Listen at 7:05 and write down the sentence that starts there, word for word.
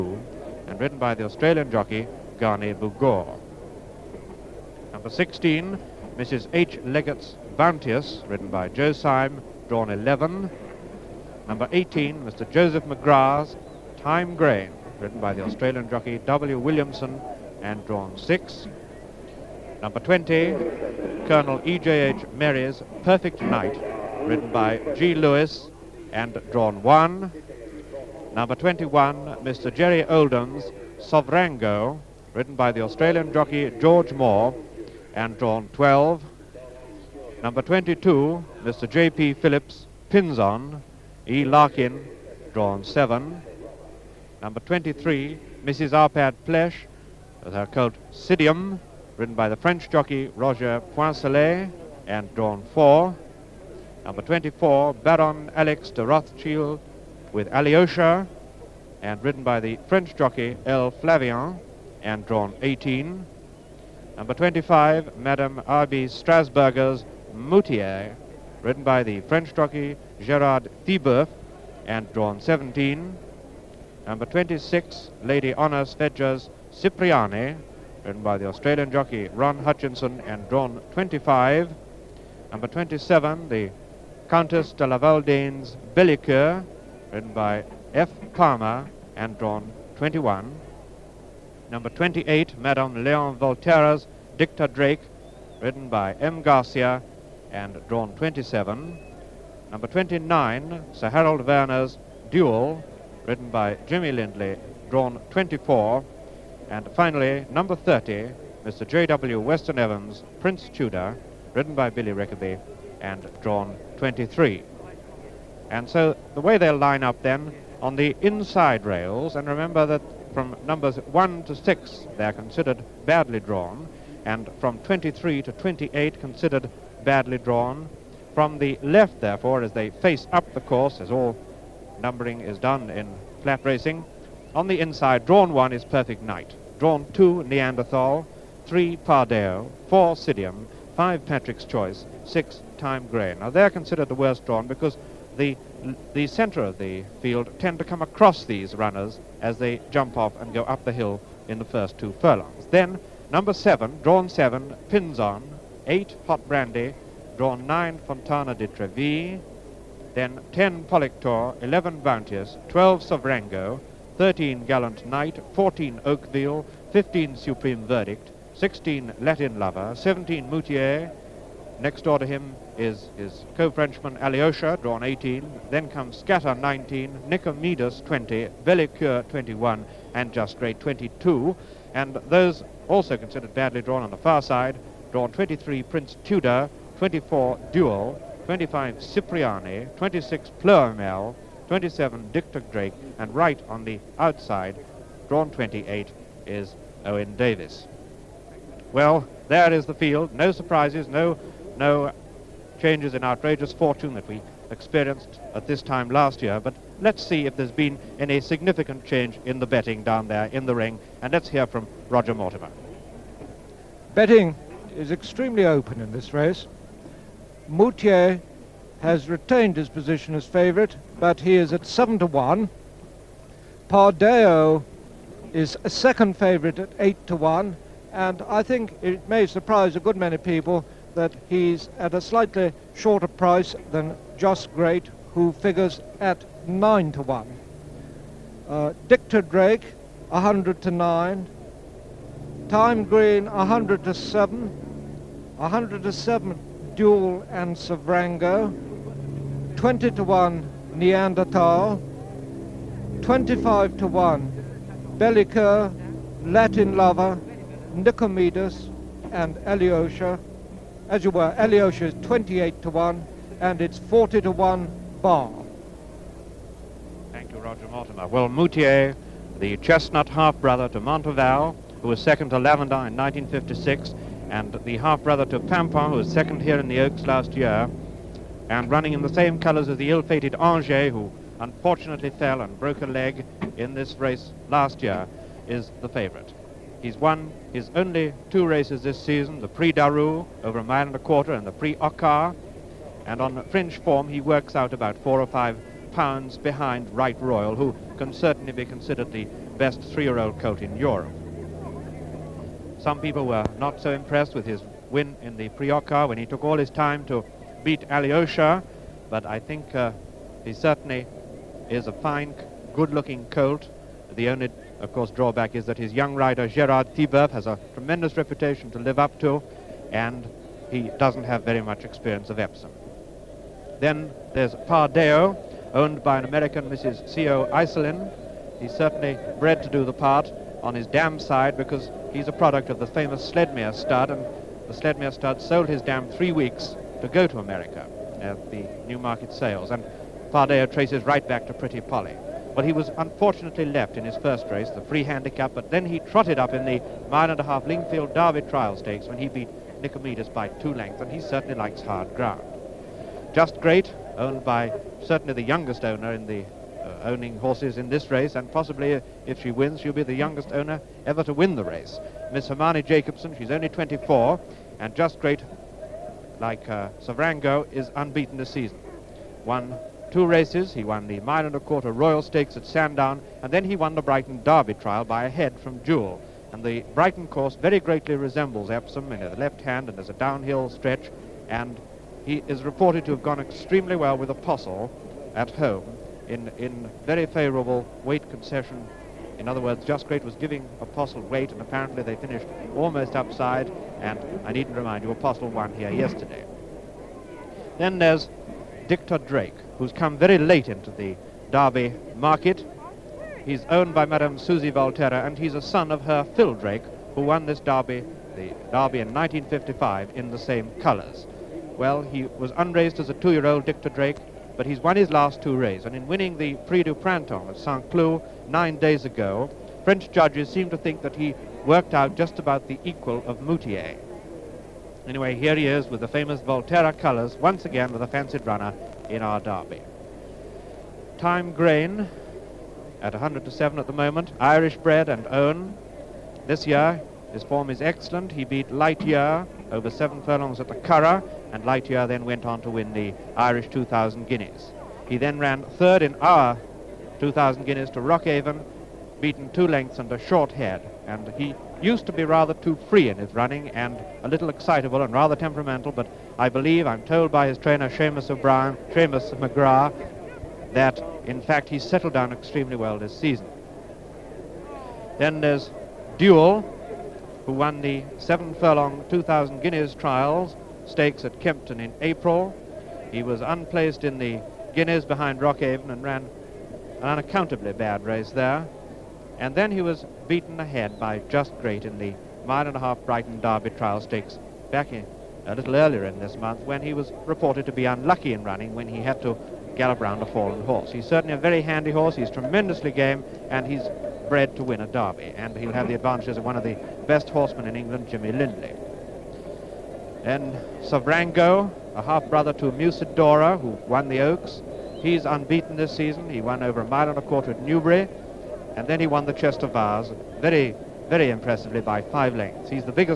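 Anyway, here he is with the famous Volterra colours, once again with a fancied runner in our derby.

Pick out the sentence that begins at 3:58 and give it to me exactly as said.
Uh, Dicta Drake, 100 to 9.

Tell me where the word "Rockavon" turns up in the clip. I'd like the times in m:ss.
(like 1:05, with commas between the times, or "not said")
7:28, 7:55.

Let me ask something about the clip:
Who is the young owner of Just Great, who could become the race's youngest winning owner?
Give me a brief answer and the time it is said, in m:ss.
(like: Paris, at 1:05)
Hermione Jacobson, at 6:02.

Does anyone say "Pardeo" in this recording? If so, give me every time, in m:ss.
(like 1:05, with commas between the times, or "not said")
2:18, 3:43, 5:24, 5:40.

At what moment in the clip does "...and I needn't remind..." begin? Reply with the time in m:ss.
6:34.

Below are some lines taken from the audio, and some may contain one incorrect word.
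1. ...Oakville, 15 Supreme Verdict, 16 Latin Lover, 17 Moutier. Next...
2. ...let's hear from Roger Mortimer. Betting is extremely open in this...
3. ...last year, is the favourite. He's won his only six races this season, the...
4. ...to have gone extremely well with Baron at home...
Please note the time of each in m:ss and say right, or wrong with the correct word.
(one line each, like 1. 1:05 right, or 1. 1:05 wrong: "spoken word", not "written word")
1. 2:46 right
2. 3:31 right
3. 4:44 wrong: "two", not "six"
4. 6:23 wrong: "Apostle", not "Baron".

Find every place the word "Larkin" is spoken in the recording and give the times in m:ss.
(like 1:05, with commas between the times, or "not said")
0:41.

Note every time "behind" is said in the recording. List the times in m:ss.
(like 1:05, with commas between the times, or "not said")
4:56, 7:55.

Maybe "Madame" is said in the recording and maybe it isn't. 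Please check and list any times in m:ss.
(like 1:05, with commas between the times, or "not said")
1:05, 1:32, 6:44.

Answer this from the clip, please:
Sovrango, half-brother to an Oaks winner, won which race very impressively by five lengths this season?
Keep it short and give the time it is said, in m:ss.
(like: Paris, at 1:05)
Chester Vase, at 8:29.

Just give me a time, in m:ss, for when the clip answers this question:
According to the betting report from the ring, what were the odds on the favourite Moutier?
3:41.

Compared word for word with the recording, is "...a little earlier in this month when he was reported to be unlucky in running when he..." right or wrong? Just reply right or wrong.
right.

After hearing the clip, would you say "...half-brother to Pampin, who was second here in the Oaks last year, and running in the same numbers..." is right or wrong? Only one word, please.
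wrong.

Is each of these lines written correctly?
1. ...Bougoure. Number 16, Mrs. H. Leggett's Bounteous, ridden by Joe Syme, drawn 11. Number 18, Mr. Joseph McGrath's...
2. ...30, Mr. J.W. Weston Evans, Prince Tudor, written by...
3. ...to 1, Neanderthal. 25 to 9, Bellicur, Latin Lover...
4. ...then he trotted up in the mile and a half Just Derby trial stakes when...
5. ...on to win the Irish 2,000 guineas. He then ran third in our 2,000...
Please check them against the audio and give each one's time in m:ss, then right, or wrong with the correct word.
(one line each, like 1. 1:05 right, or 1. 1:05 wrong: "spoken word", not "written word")
1. 0:02 right
2. 1:47 right
3. 4:10 wrong: "1", not "9"
4. 5:45 wrong: "Lingfield", not "Just"
5. 7:22 right.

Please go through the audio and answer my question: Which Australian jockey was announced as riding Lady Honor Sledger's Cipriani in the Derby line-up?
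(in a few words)
Ron Hutchinson.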